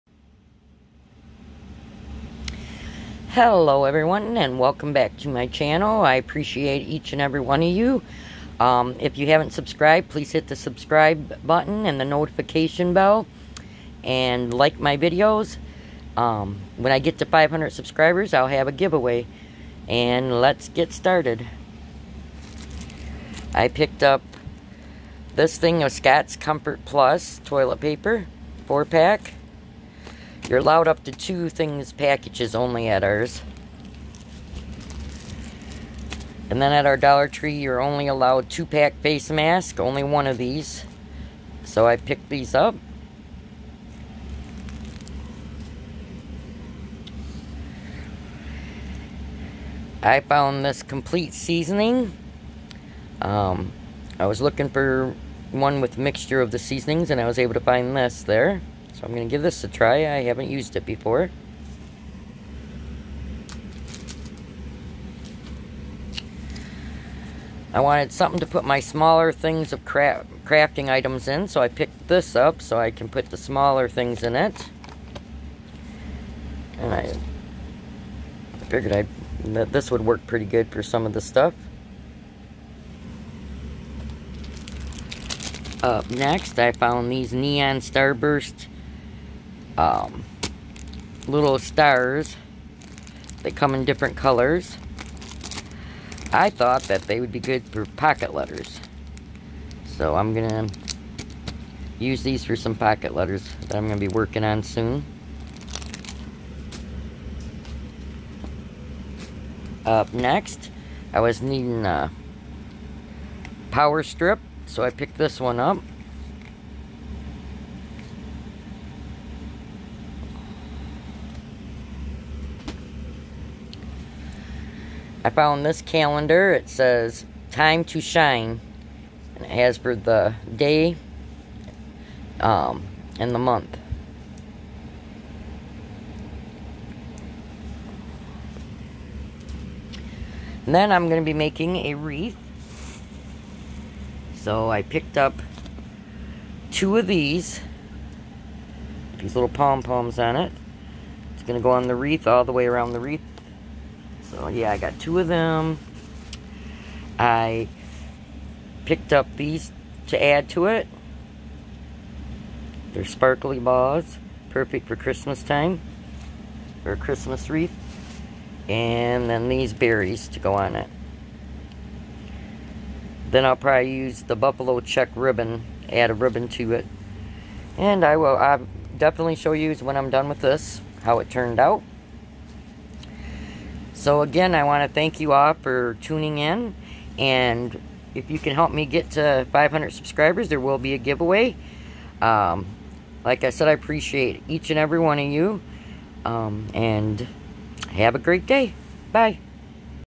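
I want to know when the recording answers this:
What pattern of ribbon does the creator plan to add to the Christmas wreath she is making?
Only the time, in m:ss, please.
2:54.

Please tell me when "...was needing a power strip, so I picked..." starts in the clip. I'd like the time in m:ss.
1:51.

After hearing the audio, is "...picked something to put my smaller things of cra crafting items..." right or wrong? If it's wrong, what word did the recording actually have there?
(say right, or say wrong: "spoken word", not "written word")
wrong: "wanted", not "picked".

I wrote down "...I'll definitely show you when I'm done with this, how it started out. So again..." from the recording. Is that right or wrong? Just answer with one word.
wrong.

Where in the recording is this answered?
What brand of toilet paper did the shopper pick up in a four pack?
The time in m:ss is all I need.
0:25.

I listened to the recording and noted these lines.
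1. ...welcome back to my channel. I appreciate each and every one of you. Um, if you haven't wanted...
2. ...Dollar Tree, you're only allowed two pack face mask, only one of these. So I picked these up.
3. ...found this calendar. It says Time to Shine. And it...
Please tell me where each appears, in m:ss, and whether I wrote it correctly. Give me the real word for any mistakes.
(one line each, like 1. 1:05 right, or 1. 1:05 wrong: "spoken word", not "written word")
1. 0:04 wrong: "subscribed", not "wanted"
2. 0:36 right
3. 2:05 right.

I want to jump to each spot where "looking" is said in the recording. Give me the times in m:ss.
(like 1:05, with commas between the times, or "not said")
0:54.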